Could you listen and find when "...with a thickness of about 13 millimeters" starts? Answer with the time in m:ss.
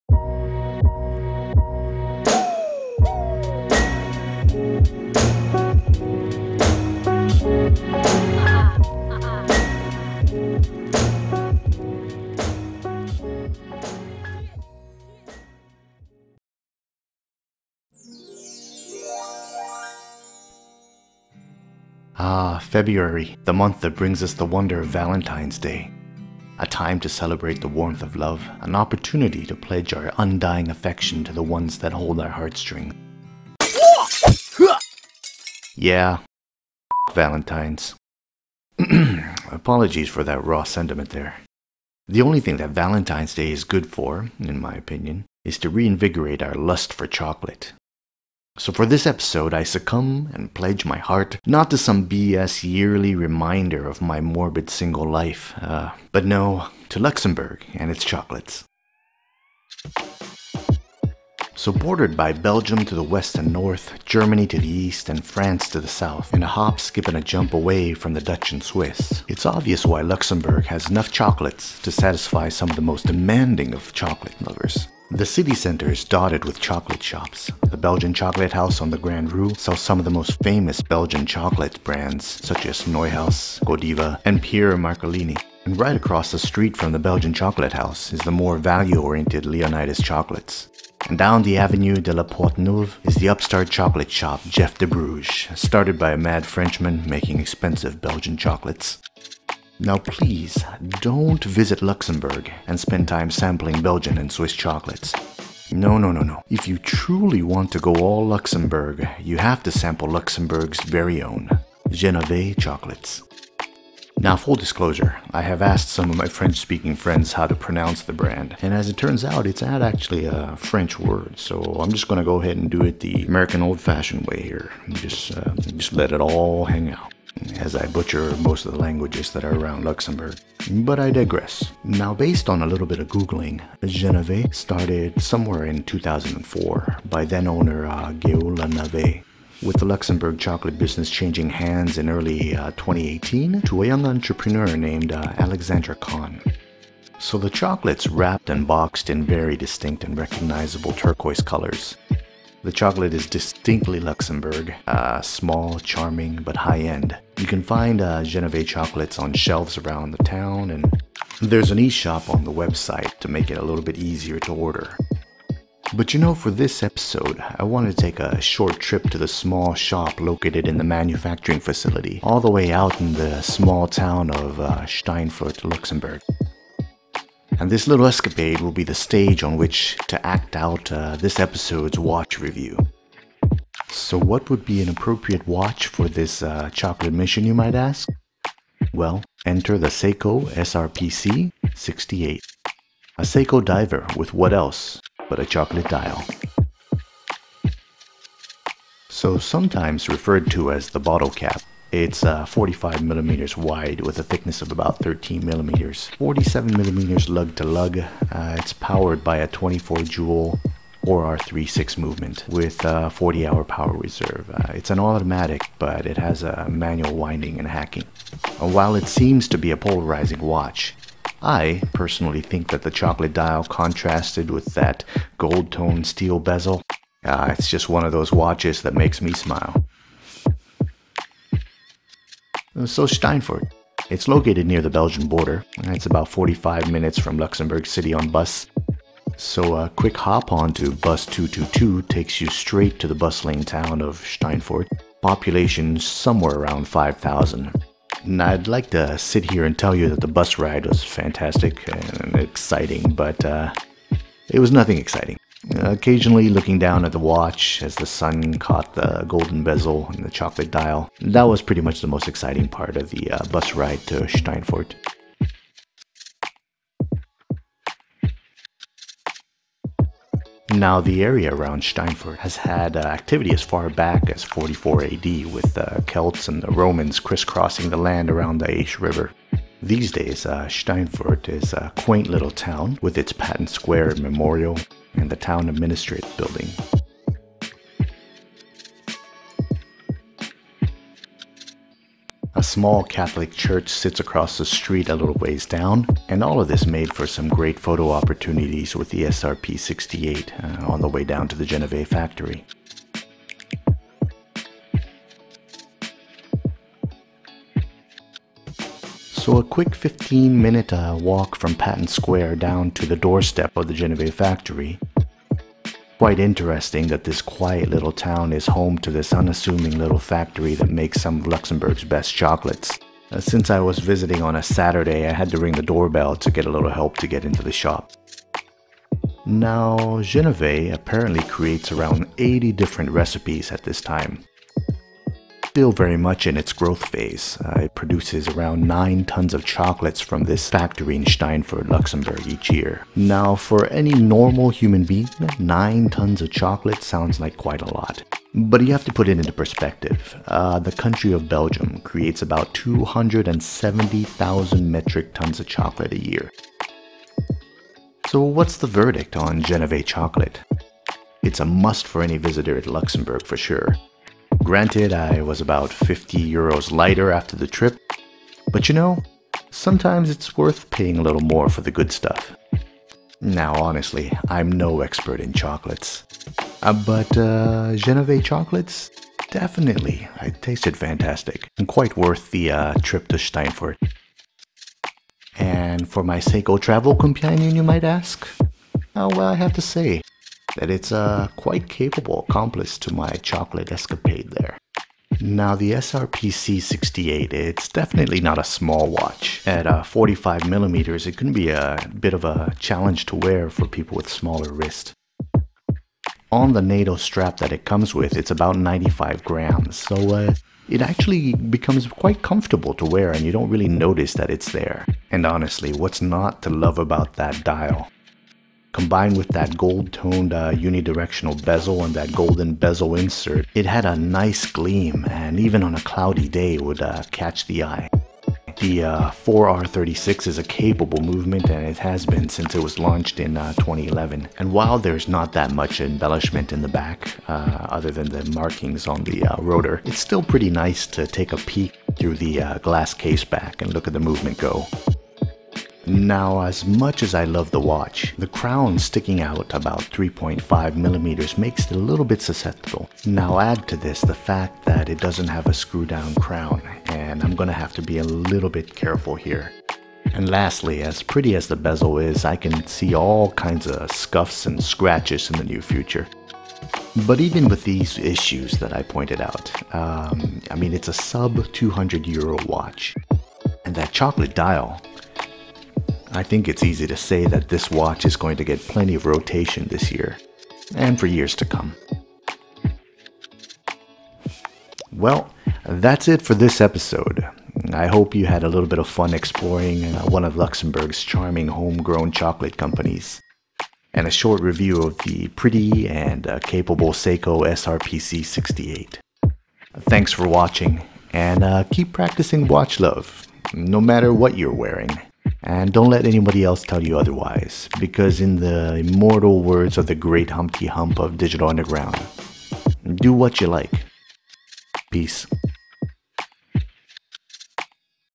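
3:24.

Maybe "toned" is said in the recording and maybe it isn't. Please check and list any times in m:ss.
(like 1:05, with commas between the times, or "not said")
3:45, 7:00.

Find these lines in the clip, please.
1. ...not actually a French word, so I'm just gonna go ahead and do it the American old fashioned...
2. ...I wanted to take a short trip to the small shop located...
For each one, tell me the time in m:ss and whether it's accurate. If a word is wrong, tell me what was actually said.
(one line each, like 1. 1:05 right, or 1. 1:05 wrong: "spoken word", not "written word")
1. 1:59 right
2. 2:47 right.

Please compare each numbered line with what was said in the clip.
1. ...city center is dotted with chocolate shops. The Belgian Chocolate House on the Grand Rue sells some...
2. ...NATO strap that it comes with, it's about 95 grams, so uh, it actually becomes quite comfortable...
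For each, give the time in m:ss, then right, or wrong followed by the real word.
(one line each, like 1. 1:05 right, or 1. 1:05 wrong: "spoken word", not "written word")
1. 1:15 right
2. 6:46 right.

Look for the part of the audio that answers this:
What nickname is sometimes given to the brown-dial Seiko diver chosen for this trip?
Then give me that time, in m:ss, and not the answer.
3:20.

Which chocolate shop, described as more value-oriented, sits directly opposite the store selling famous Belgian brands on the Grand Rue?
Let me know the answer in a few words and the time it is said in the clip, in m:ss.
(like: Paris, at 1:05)
Leonidas Chocolates, at 1:29.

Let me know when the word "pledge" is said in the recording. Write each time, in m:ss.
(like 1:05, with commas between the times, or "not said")
0:29, 0:50.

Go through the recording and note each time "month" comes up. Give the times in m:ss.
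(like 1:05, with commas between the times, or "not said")
0:23.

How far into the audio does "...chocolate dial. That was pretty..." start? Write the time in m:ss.
4:20.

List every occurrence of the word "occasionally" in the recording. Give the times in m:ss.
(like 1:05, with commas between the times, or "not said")
4:15.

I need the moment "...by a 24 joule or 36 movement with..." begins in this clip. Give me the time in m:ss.
3:29.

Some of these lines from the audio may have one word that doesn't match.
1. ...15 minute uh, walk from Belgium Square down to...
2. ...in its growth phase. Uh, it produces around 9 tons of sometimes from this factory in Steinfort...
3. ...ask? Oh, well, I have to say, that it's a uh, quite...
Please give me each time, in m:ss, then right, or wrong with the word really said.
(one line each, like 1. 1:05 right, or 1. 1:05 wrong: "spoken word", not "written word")
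1. 5:09 wrong: "Patton", not "Belgium"
2. 5:36 wrong: "chocolates", not "sometimes"
3. 6:28 right.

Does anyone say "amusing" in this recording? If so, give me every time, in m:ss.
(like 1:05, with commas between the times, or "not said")
not said.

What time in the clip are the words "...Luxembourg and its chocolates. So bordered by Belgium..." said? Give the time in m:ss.
0:56.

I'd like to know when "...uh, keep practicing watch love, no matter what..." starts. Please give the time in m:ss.
8:21.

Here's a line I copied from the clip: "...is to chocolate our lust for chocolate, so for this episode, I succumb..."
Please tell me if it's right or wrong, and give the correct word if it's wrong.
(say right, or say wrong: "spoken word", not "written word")
wrong: "reinvigorate", not "chocolate".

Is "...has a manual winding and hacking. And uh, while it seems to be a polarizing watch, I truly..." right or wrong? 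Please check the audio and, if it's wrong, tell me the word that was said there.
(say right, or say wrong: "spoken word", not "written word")
wrong: "personally", not "truly".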